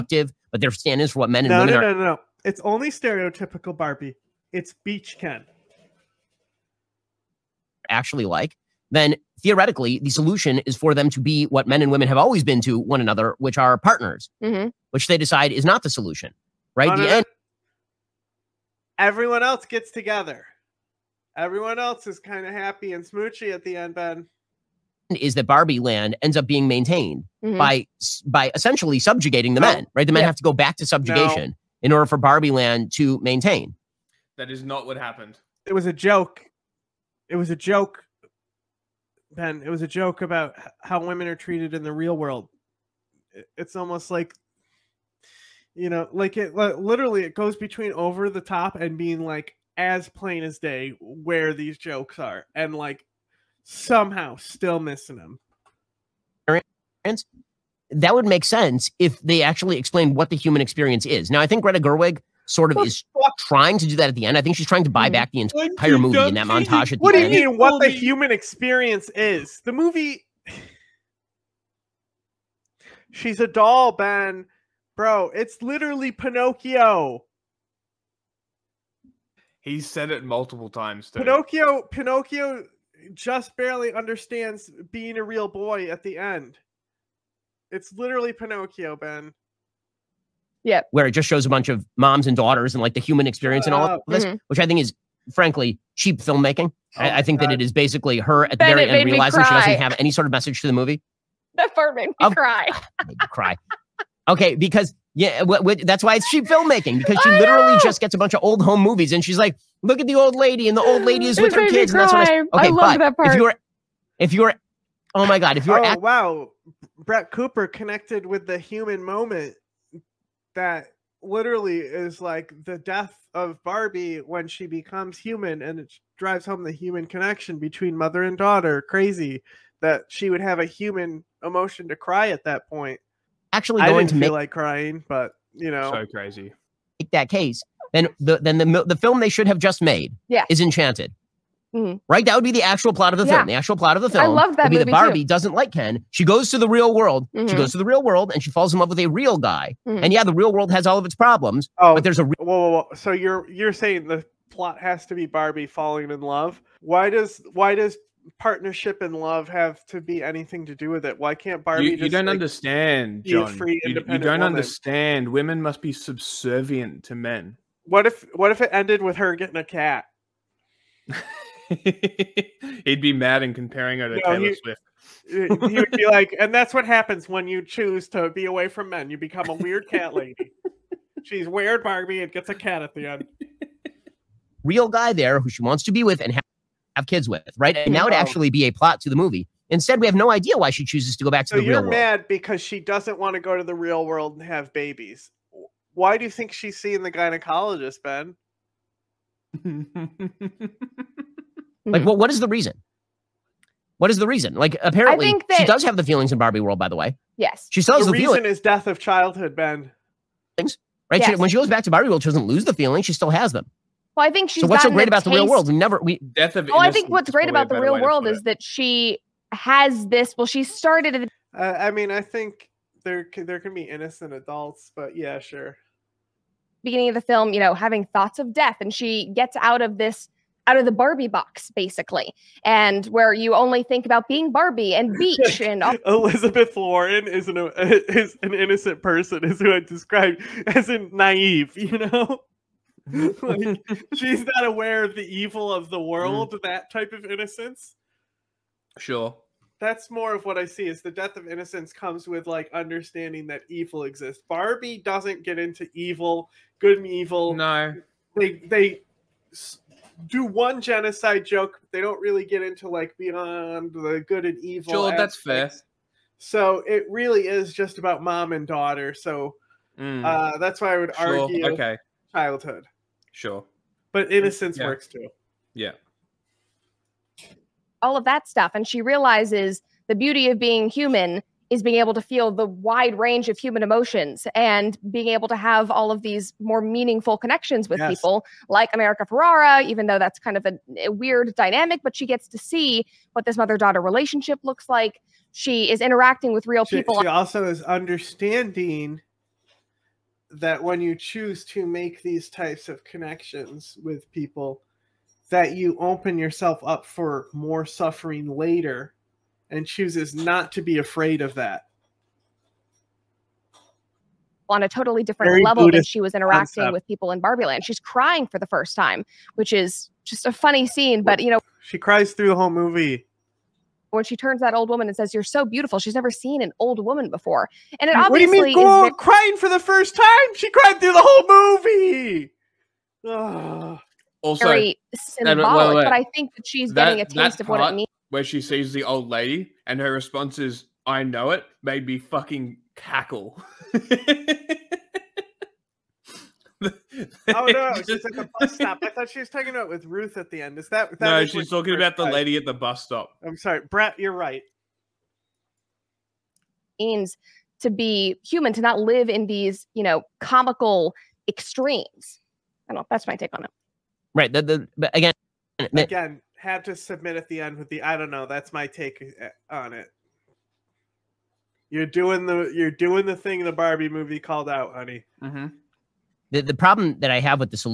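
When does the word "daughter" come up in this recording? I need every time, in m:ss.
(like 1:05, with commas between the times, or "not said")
1:32, 2:08, 4:28, 4:53.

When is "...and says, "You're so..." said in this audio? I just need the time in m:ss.
5:25.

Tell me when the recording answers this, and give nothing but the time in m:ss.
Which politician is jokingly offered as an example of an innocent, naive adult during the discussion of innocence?
3:56.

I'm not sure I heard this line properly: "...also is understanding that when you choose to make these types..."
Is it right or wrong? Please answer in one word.
right.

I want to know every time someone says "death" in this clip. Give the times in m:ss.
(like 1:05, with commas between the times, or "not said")
2:02, 3:28, 3:36, 3:48, 4:11.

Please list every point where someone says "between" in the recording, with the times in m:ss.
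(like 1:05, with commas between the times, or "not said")
0:47, 2:07.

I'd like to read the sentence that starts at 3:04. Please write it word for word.
Real guy there who she wants to be with and has have kids with, right?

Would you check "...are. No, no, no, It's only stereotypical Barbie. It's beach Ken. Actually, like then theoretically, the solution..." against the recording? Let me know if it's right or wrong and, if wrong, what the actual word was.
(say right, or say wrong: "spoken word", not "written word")
right.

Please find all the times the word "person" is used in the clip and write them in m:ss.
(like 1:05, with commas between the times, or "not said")
3:59.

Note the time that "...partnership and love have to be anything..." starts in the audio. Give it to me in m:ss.
2:38.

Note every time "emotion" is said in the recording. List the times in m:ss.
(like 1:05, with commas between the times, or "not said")
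2:11, 4:43.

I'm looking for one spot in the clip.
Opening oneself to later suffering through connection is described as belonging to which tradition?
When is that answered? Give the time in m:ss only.
5:15.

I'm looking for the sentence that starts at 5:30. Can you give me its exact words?
She cried through the whole movie.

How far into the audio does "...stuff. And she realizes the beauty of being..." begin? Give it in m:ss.
4:38.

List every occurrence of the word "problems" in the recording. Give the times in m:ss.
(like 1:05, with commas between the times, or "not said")
2:31, 6:16.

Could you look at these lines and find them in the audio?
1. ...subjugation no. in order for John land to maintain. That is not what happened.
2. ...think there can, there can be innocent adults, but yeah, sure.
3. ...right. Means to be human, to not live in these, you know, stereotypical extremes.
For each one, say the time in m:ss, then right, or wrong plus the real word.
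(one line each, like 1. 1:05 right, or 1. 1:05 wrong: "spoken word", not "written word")
1. 0:30 wrong: "Barbie", not "John"
2. 3:42 right
3. 5:54 wrong: "comical", not "stereotypical".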